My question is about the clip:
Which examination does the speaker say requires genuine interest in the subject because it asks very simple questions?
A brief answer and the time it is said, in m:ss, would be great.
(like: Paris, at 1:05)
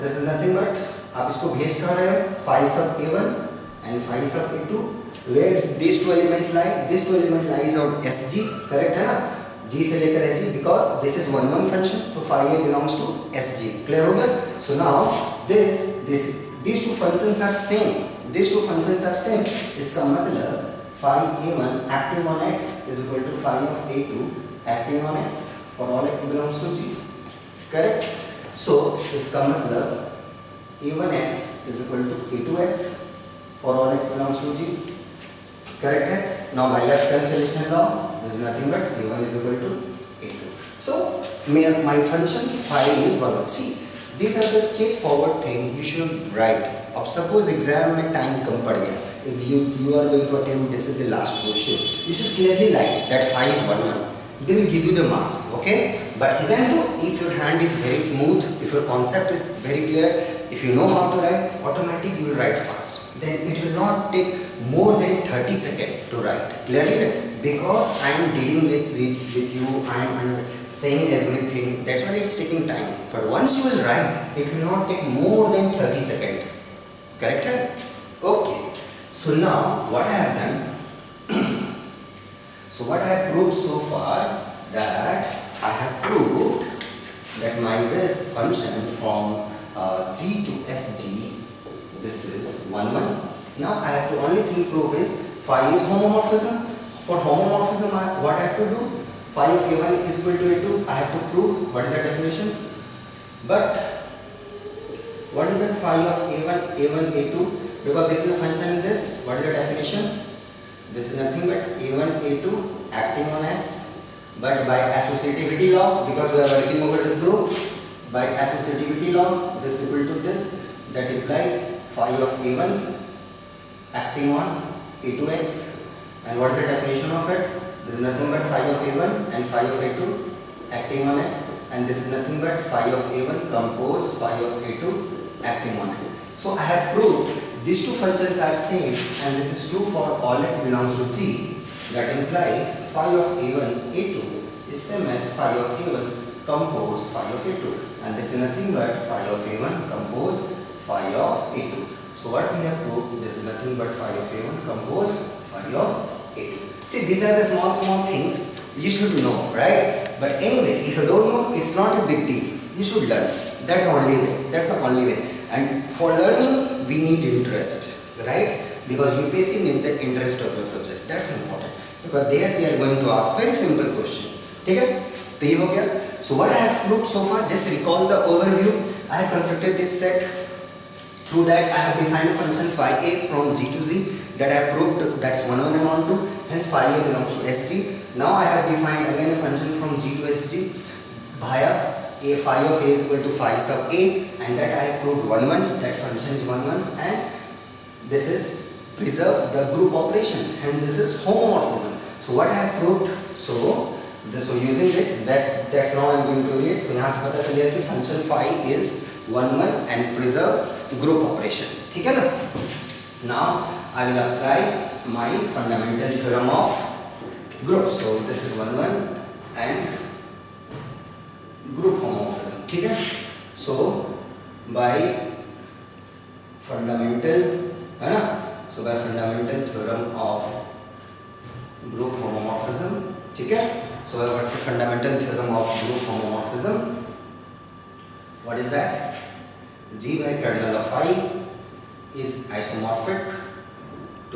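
UPSC, at 2:49.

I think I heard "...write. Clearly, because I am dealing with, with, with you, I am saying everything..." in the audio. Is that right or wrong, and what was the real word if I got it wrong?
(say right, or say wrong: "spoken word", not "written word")
right.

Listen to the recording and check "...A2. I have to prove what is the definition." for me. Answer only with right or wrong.
right.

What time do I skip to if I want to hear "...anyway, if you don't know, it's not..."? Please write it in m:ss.
2:40.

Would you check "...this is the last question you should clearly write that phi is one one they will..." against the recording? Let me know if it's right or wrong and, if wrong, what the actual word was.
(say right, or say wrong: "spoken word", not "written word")
right.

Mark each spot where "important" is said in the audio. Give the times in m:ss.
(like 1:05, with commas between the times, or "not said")
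2:51.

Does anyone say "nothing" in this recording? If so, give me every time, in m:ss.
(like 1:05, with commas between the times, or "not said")
0:38, 1:51, 2:08, 2:12, 2:28, 2:33.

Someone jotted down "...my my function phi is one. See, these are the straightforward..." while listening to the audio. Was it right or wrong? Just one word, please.
right.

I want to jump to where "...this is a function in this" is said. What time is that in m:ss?
1:48.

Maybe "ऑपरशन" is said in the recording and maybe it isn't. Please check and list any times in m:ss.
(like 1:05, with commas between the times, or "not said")
3:31.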